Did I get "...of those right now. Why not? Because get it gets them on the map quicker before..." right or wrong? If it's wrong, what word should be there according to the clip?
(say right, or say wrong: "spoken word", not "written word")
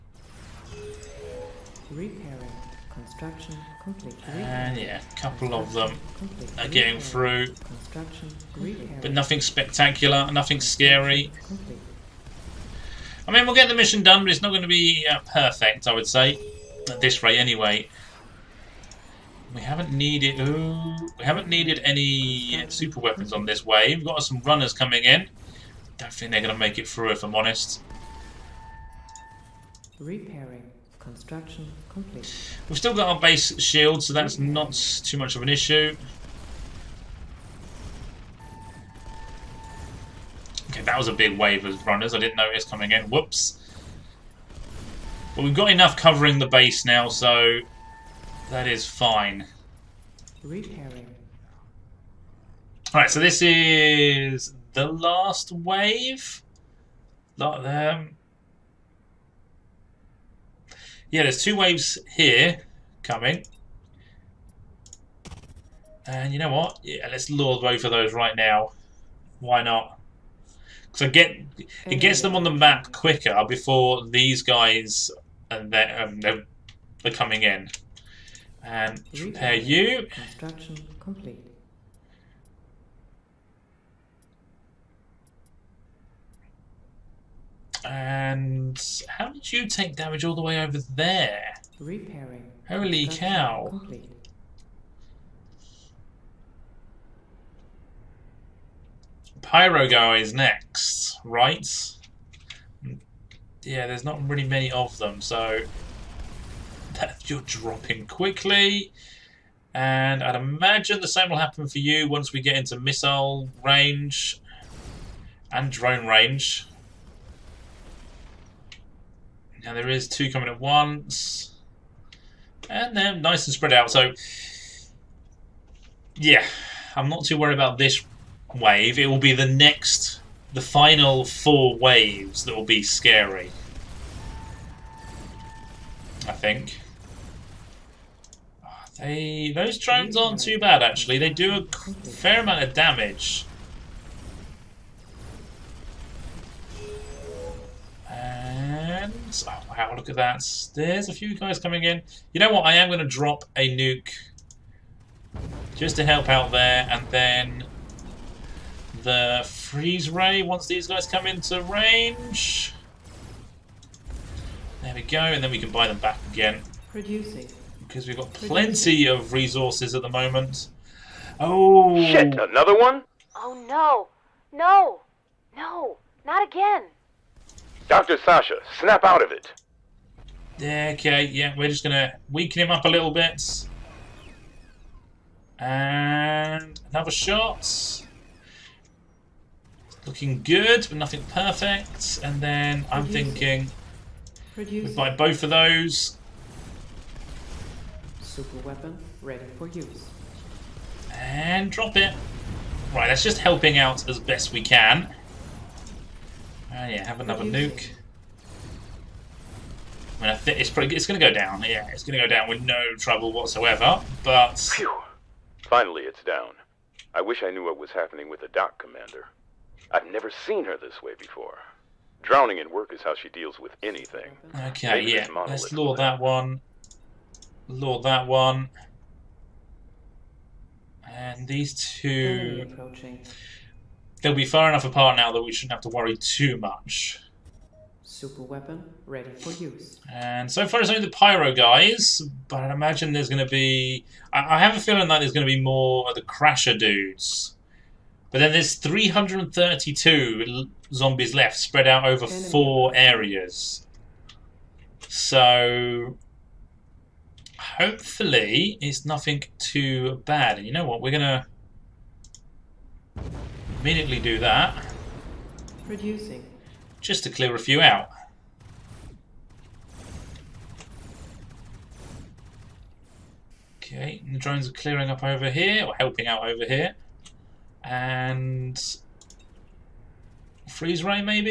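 right.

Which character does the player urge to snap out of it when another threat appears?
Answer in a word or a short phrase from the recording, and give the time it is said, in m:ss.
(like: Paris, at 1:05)
Dr. Sasha, at 2:57.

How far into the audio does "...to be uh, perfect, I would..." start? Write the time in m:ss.
0:14.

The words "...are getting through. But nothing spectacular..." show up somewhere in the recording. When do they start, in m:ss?
0:06.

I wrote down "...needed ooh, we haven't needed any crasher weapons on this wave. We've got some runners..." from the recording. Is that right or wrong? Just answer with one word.
wrong.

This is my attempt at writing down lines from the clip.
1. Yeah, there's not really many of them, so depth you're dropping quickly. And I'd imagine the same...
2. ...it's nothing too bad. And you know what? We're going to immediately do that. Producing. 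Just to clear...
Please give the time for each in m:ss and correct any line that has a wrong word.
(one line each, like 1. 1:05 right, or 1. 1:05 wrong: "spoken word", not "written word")
1. 1:43 right
2. 4:18 right.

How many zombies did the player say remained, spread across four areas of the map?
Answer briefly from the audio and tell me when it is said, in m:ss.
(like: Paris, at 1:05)
332, at 4:08.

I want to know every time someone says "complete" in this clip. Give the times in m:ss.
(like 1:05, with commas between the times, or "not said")
0:03, 0:31, 1:20, 1:33.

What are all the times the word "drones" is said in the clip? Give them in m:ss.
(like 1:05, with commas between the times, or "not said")
1:55, 2:19, 4:34.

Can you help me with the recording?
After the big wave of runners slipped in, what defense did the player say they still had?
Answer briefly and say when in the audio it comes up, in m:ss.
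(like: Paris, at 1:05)
Base shield, at 0:33.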